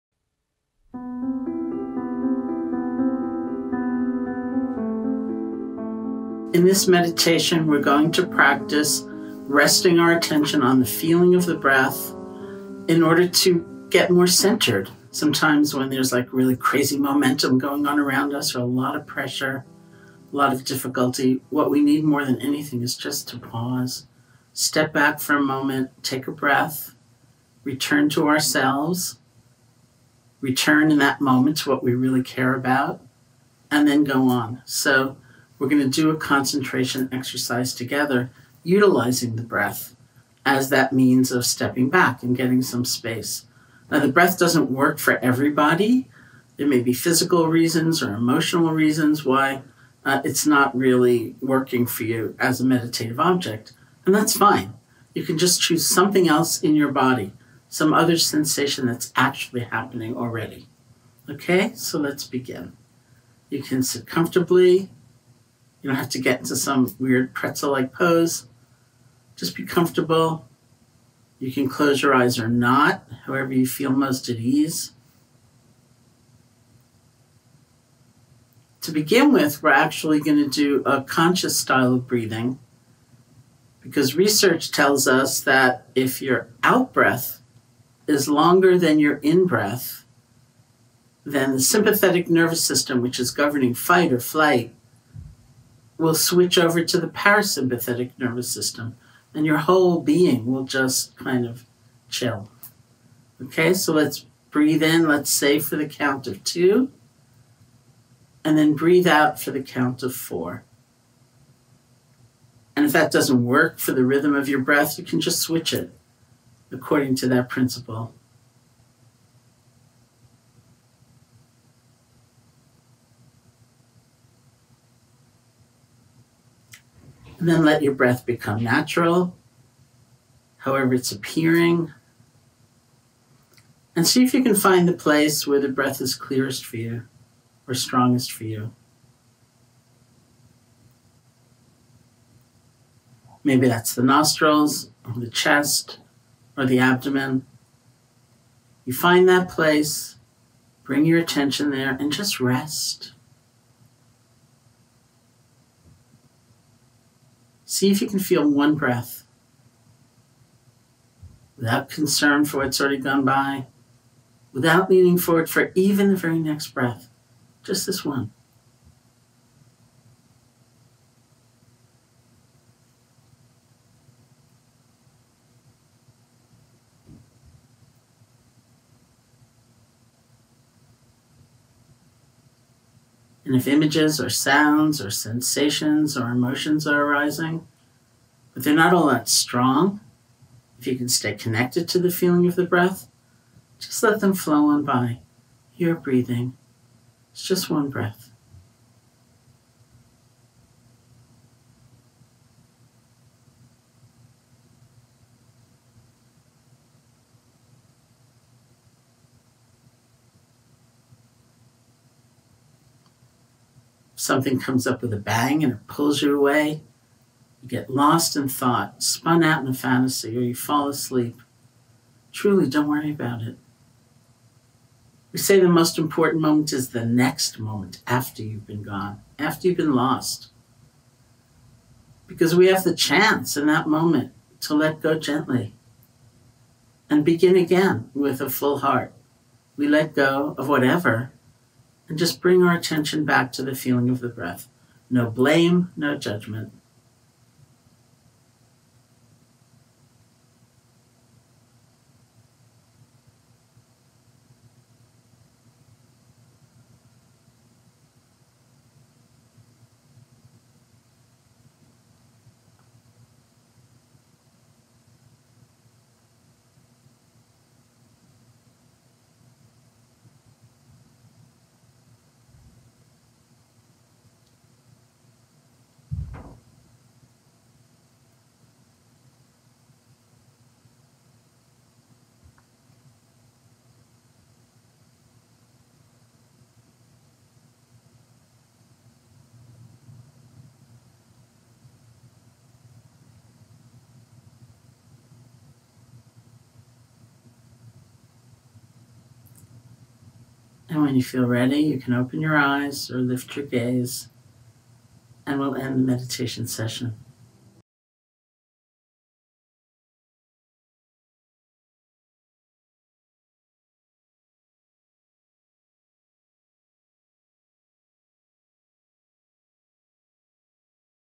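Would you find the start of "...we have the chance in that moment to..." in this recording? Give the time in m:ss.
3:52.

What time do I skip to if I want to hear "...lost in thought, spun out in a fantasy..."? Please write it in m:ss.
3:37.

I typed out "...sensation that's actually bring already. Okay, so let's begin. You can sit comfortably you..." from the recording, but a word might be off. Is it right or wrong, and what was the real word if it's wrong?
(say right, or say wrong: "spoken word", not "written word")
wrong: "happening", not "bring".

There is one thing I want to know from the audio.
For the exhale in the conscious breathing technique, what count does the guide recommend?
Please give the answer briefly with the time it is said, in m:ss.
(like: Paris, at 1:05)
4, at 1:50.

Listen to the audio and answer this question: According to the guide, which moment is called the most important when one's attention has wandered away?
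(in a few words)
the next moment.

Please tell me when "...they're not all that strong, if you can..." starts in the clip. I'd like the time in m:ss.
3:08.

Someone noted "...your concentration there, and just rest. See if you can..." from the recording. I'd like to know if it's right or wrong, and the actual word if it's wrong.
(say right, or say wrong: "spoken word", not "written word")
wrong: "attention", not "concentration".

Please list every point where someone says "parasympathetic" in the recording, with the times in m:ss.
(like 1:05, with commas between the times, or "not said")
1:37.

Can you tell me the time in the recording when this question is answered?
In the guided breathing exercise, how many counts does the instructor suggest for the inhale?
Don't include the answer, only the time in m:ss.
1:46.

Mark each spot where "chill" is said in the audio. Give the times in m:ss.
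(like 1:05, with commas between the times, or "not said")
1:42.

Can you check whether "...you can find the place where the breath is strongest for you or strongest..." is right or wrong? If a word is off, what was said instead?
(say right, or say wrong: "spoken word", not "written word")
wrong: "clearest", not "strongest".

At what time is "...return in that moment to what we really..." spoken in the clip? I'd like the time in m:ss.
0:30.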